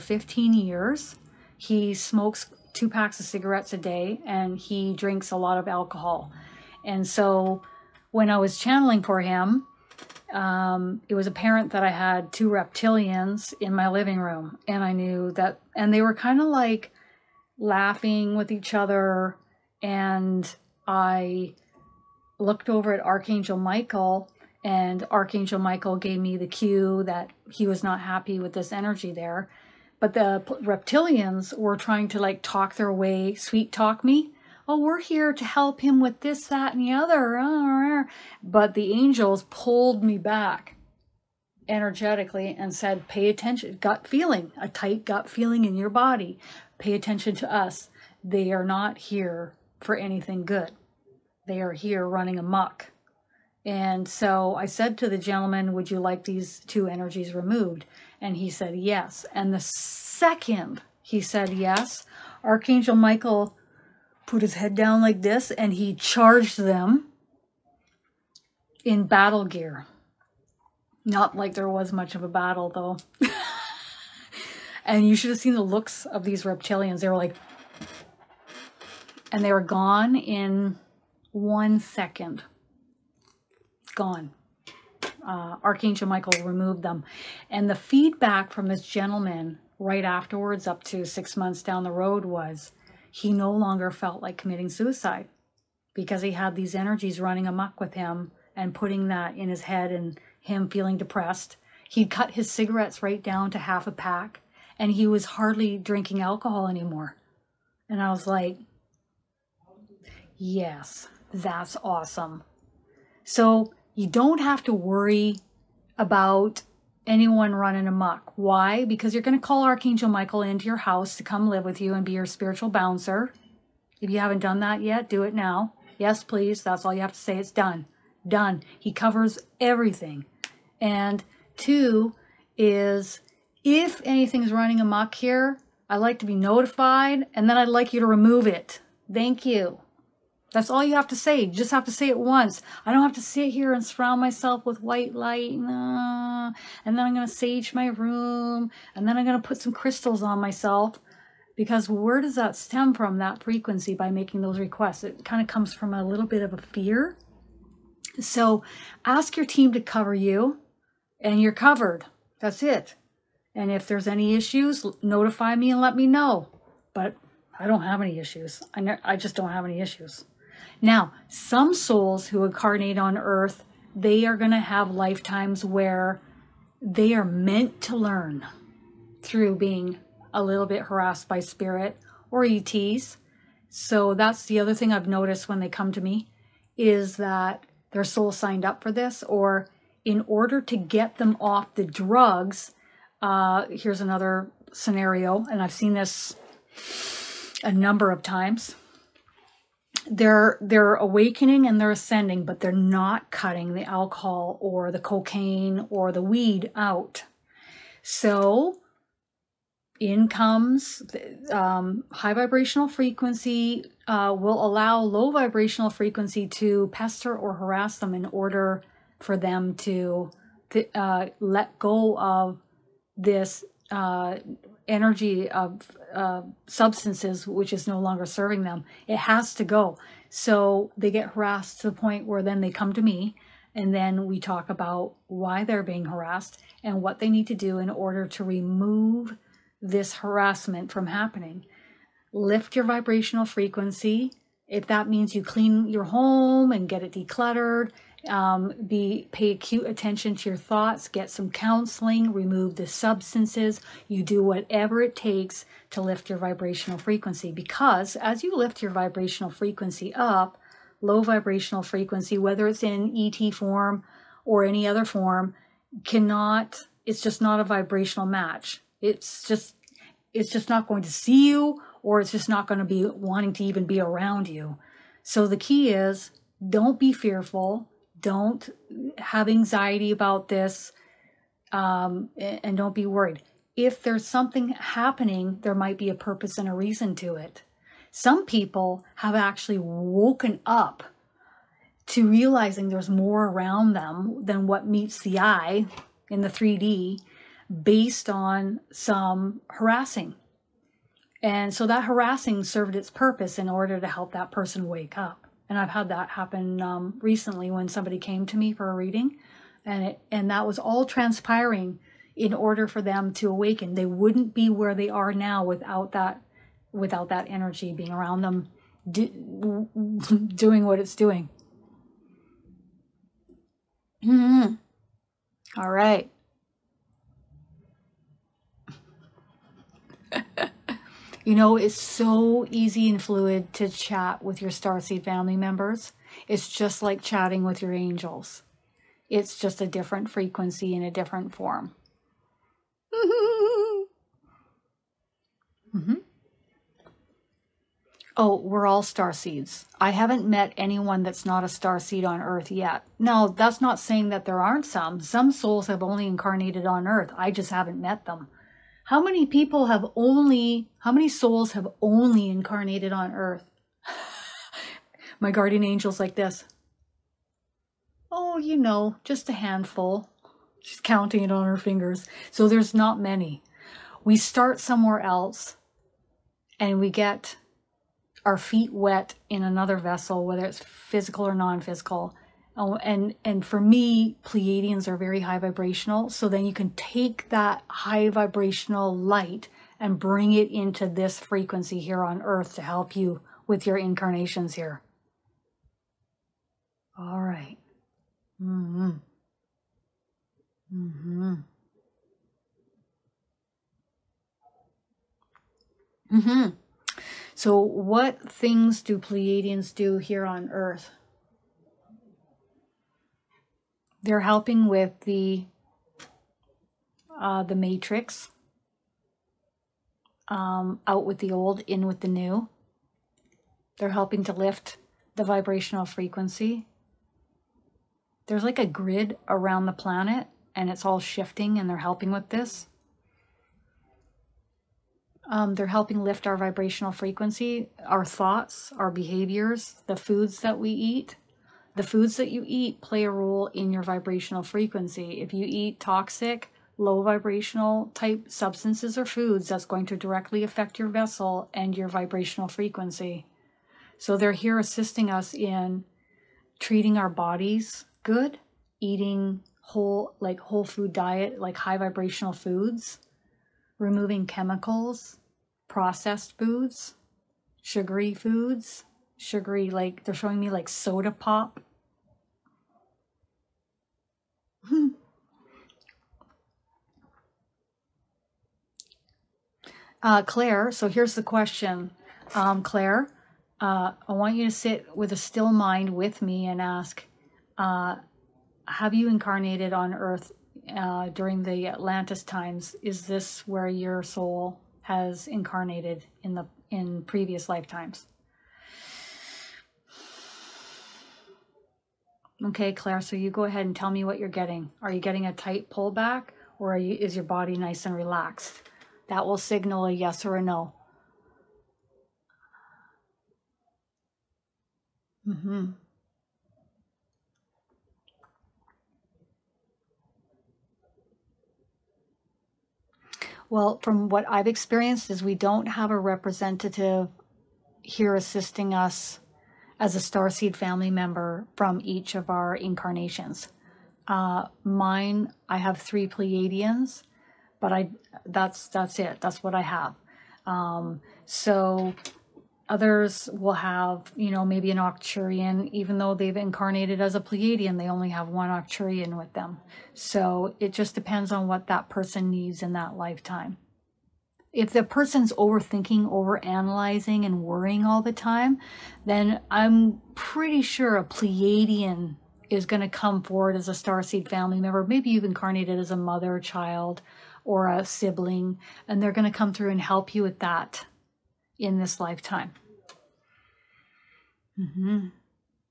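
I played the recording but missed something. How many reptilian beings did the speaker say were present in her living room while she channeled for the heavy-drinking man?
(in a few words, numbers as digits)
2.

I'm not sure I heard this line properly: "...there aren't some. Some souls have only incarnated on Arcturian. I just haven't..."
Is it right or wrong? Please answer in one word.
wrong.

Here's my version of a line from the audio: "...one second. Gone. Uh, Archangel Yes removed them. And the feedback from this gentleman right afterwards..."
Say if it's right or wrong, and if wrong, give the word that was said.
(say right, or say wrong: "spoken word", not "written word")
wrong: "Michael", not "Yes".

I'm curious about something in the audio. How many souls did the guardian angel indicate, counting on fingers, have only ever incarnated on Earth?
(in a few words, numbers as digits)
just a handful.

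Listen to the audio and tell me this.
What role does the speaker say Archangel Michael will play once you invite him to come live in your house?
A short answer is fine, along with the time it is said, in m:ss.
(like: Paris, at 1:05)
spiritual bouncer, at 2:02.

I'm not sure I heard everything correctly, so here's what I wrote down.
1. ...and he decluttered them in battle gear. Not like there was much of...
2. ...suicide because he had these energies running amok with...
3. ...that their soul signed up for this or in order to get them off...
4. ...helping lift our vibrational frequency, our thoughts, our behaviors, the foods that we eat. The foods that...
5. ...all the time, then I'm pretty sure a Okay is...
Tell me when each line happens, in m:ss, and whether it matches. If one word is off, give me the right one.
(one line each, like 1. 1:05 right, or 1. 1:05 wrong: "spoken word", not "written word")
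1. 1:05 wrong: "charged", not "decluttered"
2. 1:34 right
3. 3:07 right
4. 7:15 right
5. 9:18 wrong: "Pleiadian", not "Okay".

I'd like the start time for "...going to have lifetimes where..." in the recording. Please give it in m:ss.
2:54.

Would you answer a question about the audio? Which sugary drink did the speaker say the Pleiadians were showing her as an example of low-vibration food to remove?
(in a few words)
soda pop.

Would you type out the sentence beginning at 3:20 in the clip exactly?
They're they're awakening and they're ascending, but they're not cutting the alcohol or the cocaine or the weed out.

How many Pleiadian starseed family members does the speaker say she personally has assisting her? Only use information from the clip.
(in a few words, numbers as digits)
3.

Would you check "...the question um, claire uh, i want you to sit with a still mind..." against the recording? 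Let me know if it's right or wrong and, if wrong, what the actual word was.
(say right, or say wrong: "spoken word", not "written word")
right.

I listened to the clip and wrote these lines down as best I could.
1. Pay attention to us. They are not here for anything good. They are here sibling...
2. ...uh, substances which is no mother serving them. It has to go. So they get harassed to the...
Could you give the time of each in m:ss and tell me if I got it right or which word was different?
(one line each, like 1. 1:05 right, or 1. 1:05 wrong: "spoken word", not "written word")
1. 0:46 wrong: "running", not "sibling"
2. 3:46 wrong: "longer", not "mother".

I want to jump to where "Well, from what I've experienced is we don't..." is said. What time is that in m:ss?
8:43.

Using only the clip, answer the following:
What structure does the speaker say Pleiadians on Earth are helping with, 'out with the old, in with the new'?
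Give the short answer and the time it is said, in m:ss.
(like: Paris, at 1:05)
the matrix, at 6:57.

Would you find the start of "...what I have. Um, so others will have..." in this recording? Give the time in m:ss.
8:59.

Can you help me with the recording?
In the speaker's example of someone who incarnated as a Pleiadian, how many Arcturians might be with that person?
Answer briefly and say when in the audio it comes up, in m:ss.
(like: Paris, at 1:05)
1, at 9:08.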